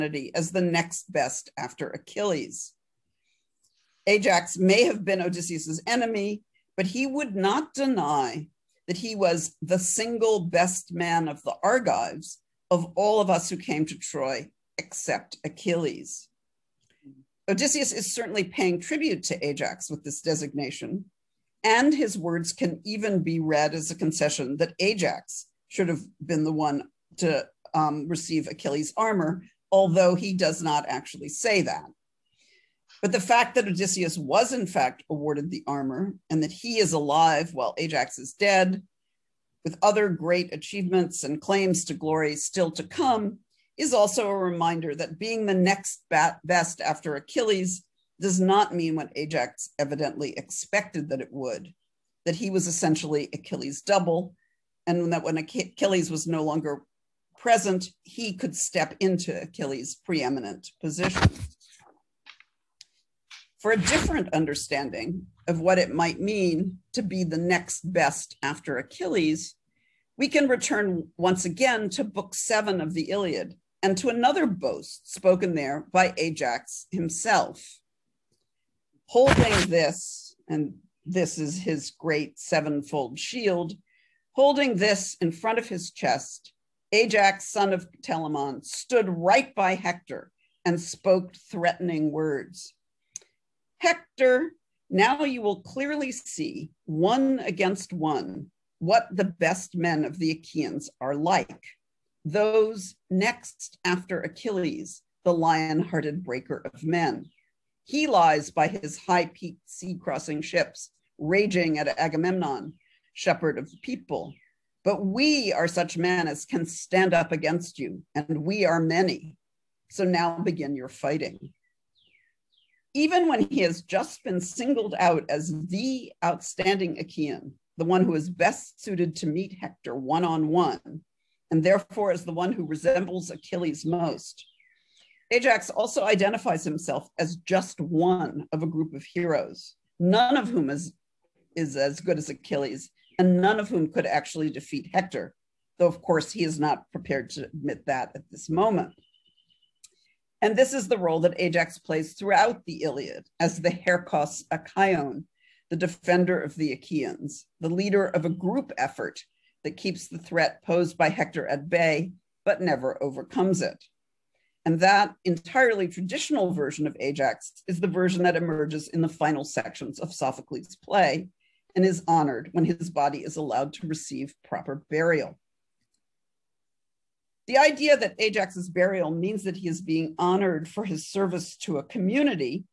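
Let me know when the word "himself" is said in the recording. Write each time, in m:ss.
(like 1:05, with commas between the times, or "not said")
1:16, 2:16.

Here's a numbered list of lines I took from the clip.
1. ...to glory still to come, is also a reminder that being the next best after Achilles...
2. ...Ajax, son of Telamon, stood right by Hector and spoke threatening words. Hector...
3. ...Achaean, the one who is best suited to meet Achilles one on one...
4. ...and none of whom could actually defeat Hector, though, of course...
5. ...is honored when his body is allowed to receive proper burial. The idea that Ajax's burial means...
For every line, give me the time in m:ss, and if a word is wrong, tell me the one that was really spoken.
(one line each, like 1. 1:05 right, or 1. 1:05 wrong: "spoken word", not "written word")
1. 0:41 right
2. 1:26 right
3. 2:06 wrong: "Hector", not "Achilles"
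4. 2:23 right
5. 2:51 right.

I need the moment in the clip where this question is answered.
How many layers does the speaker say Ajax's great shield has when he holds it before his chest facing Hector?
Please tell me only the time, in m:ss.
1:22.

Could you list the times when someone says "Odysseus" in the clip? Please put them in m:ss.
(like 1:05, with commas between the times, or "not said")
0:05, 0:17, 0:33.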